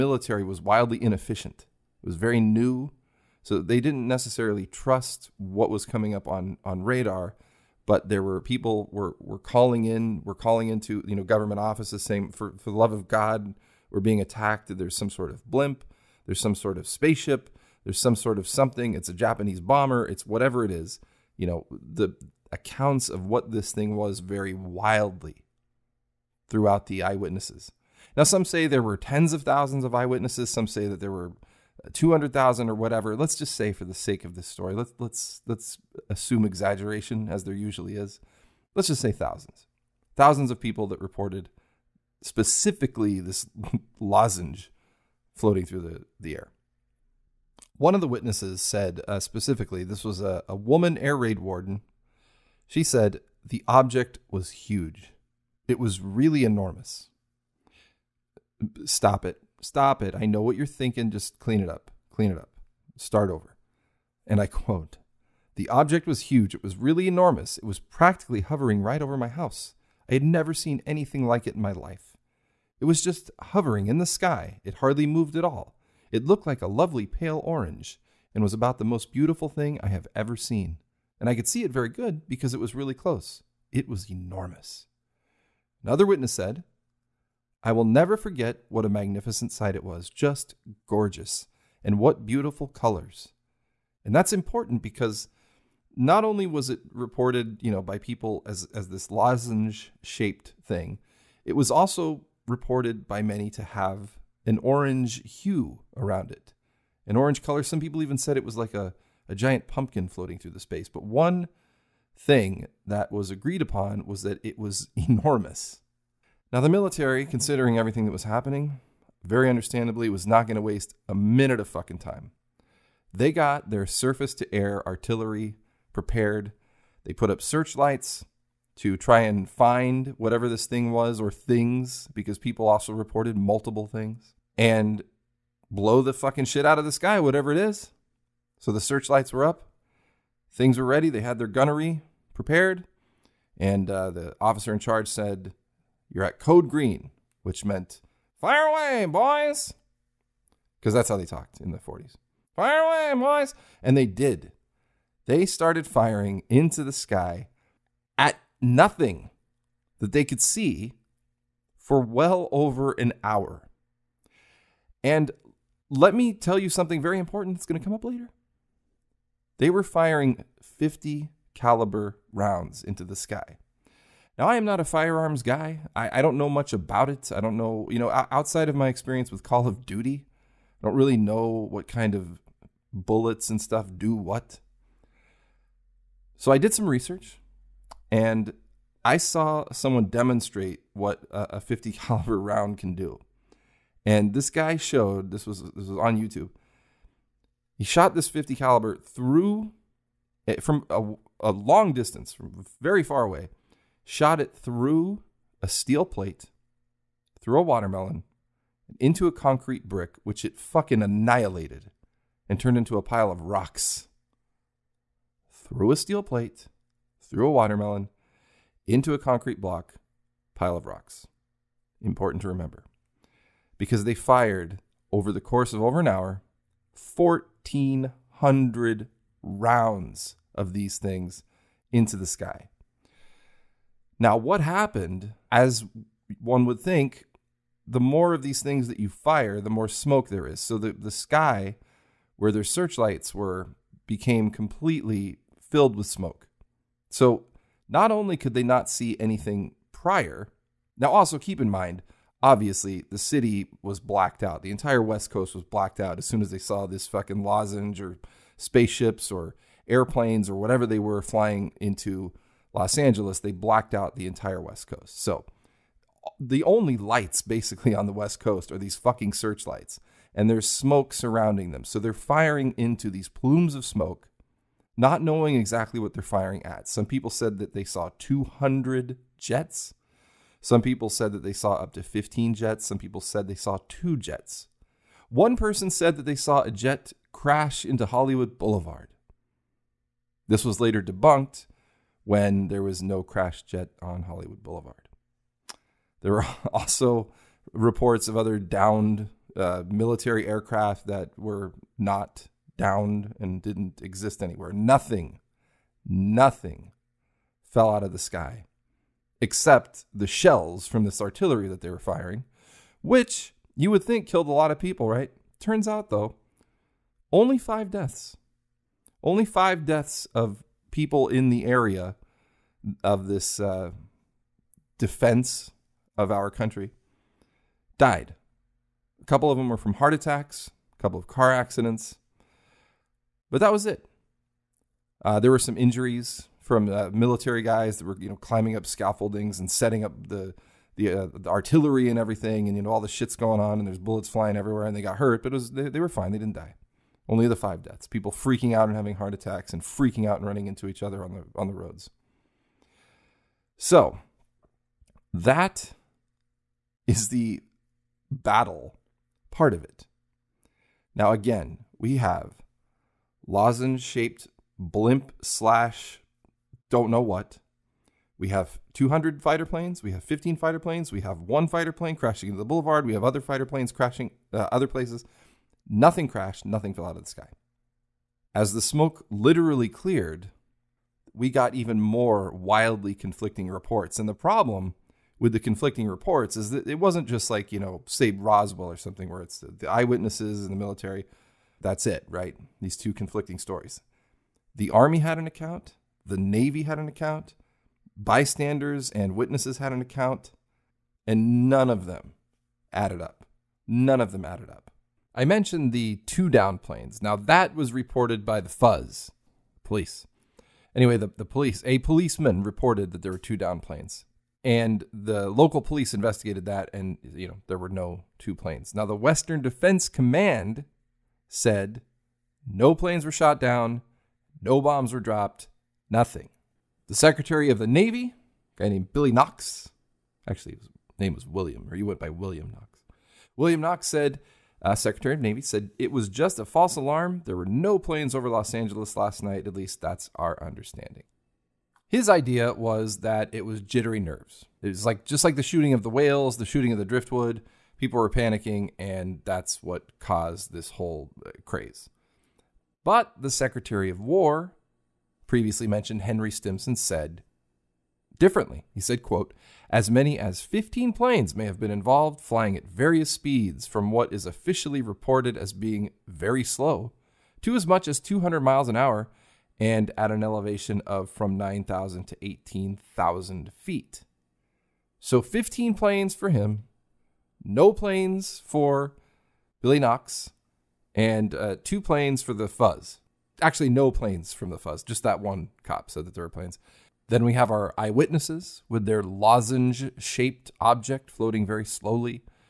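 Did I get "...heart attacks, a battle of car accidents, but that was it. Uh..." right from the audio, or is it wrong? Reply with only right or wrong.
wrong.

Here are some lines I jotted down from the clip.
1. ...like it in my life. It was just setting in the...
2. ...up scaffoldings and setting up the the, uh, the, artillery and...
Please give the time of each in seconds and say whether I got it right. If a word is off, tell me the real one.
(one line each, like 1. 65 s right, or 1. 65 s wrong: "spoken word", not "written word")
1. 71 s wrong: "hovering", not "setting"
2. 338 s right.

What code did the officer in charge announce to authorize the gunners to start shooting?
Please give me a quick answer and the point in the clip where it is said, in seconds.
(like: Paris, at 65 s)
Code green, at 146 s.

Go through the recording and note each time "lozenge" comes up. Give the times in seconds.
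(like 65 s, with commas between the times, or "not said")
43 s, 99 s, 257 s, 363 s, 489 s.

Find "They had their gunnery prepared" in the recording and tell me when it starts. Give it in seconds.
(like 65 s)
141 s.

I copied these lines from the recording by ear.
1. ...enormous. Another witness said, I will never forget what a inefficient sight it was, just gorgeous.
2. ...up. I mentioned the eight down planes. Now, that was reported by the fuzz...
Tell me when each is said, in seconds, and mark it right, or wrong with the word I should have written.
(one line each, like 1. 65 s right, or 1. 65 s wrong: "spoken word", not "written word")
1. 84 s wrong: "magnificent", not "inefficient"
2. 404 s wrong: "two", not "eight".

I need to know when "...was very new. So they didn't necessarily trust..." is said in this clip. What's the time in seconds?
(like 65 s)
2 s.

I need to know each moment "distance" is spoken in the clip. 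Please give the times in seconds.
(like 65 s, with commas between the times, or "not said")
201 s.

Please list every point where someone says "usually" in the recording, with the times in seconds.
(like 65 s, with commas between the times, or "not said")
37 s.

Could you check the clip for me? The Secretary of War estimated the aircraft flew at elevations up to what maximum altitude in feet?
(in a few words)
18,000 feet.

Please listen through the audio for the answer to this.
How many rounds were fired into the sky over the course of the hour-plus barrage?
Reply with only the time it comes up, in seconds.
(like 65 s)
227 s.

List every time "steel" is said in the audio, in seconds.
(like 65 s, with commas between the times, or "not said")
205 s, 215 s.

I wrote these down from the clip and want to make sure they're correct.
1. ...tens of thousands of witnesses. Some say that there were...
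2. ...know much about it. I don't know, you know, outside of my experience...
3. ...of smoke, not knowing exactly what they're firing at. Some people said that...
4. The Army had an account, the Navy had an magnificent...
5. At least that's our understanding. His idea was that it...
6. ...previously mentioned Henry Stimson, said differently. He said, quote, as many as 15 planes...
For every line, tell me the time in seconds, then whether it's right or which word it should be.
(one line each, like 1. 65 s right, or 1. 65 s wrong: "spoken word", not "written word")
1. 28 s wrong: "eyewitnesses", not "witnesses"
2. 176 s right
3. 273 s right
4. 394 s wrong: "account", not "magnificent"
5. 439 s right
6. 455 s right.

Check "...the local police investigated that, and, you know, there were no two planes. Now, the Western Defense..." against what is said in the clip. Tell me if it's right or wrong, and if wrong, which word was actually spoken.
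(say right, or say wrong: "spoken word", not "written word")
right.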